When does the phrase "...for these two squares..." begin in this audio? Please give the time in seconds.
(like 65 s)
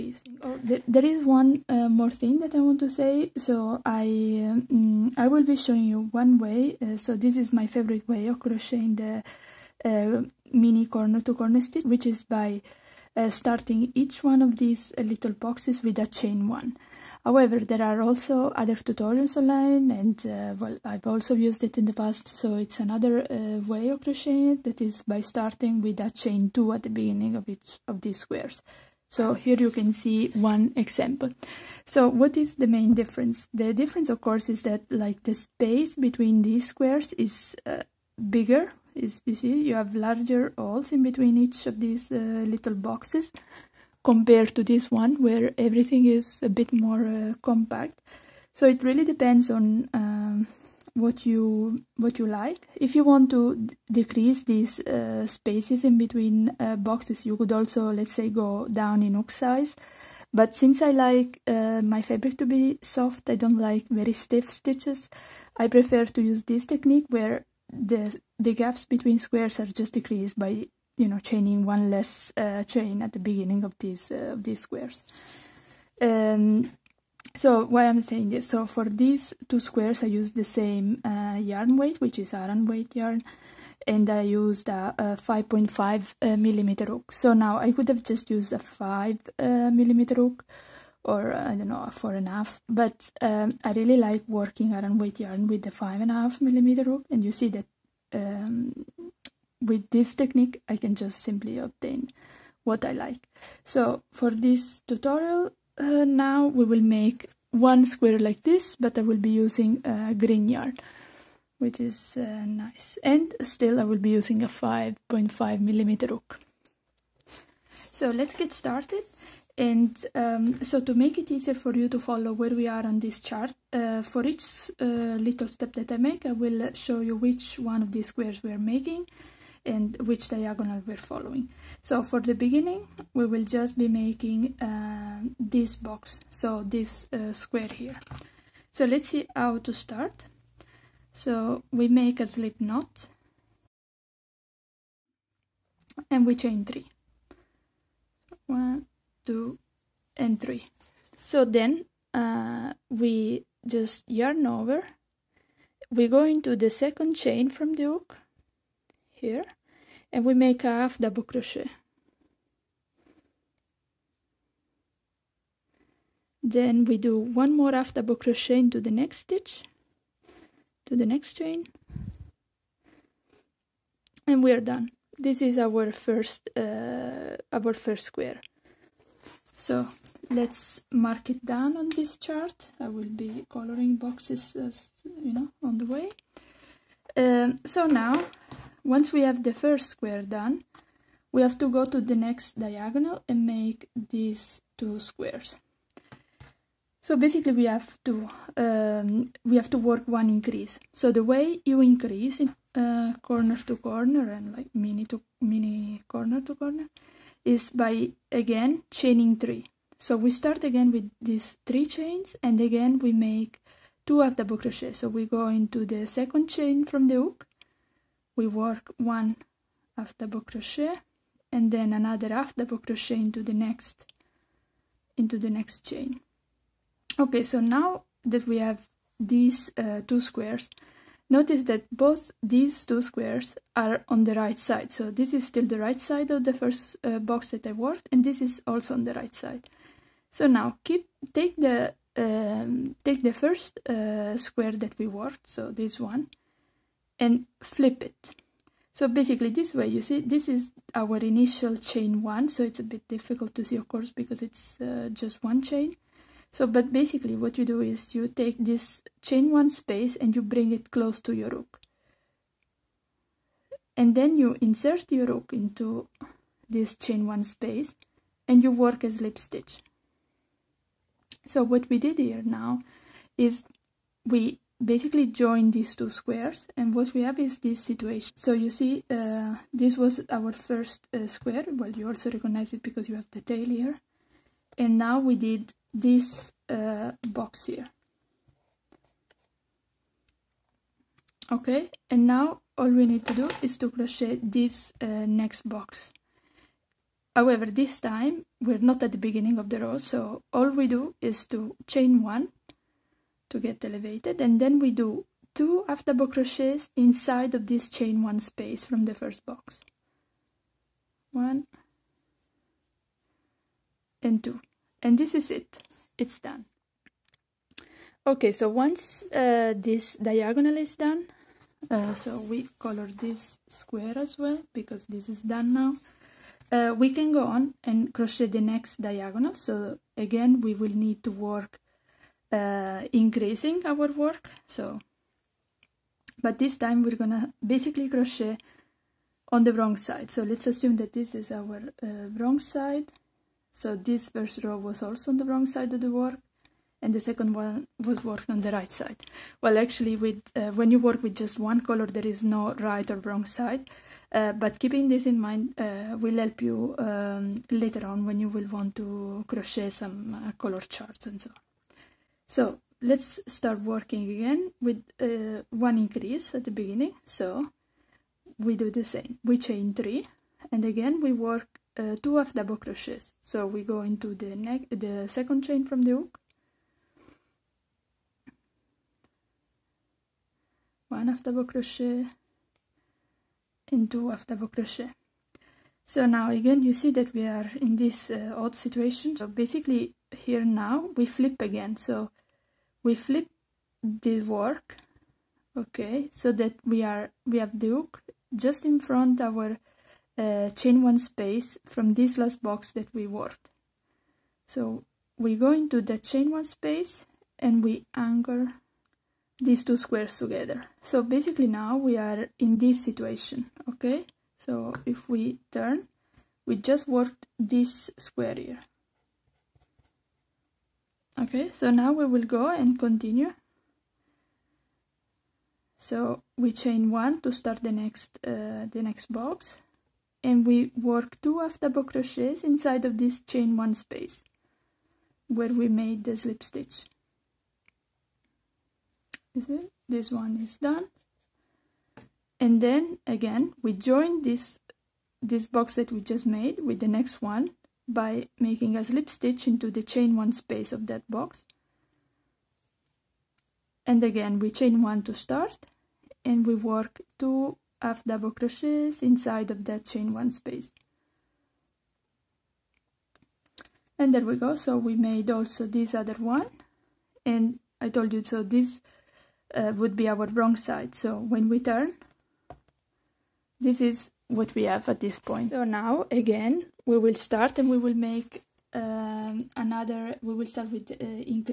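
78 s.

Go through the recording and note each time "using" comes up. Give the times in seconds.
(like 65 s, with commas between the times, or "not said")
109 s, 114 s.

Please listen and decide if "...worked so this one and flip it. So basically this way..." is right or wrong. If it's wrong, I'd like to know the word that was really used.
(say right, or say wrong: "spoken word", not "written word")
right.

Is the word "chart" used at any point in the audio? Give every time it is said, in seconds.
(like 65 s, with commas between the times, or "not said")
123 s, 182 s, 360 s.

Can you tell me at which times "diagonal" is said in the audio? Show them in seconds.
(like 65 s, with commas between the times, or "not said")
130 s, 192 s, 320 s, 329 s.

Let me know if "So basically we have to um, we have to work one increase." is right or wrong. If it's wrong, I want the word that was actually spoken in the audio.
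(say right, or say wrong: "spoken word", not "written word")
right.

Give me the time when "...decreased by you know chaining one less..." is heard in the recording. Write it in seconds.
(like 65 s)
69 s.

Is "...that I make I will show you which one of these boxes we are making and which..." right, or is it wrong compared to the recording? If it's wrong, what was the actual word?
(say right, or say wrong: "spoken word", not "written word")
wrong: "squares", not "boxes".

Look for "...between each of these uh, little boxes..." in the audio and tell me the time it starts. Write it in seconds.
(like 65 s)
41 s.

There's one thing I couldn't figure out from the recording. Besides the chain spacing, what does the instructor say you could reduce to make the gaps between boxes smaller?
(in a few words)
hook size.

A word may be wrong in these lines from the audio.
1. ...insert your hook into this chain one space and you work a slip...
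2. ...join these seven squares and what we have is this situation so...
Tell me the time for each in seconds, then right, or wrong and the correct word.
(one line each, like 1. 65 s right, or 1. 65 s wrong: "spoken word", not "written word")
1. 264 s right
2. 275 s wrong: "two", not "seven".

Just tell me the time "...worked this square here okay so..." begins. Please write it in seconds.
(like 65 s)
417 s.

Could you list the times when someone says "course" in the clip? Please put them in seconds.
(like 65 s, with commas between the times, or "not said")
34 s, 253 s.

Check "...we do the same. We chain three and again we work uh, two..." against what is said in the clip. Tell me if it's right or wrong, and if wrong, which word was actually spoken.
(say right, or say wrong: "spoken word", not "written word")
right.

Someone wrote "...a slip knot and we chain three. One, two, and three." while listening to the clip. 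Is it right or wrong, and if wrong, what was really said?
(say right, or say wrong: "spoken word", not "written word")
right.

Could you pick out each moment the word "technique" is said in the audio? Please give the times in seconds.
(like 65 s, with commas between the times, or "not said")
66 s, 100 s.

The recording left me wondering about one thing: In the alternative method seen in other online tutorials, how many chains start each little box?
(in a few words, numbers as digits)
2.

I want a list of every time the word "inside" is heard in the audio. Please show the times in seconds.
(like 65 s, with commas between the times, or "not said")
306 s, 432 s, 459 s.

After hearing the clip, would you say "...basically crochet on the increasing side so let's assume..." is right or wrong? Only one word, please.
wrong.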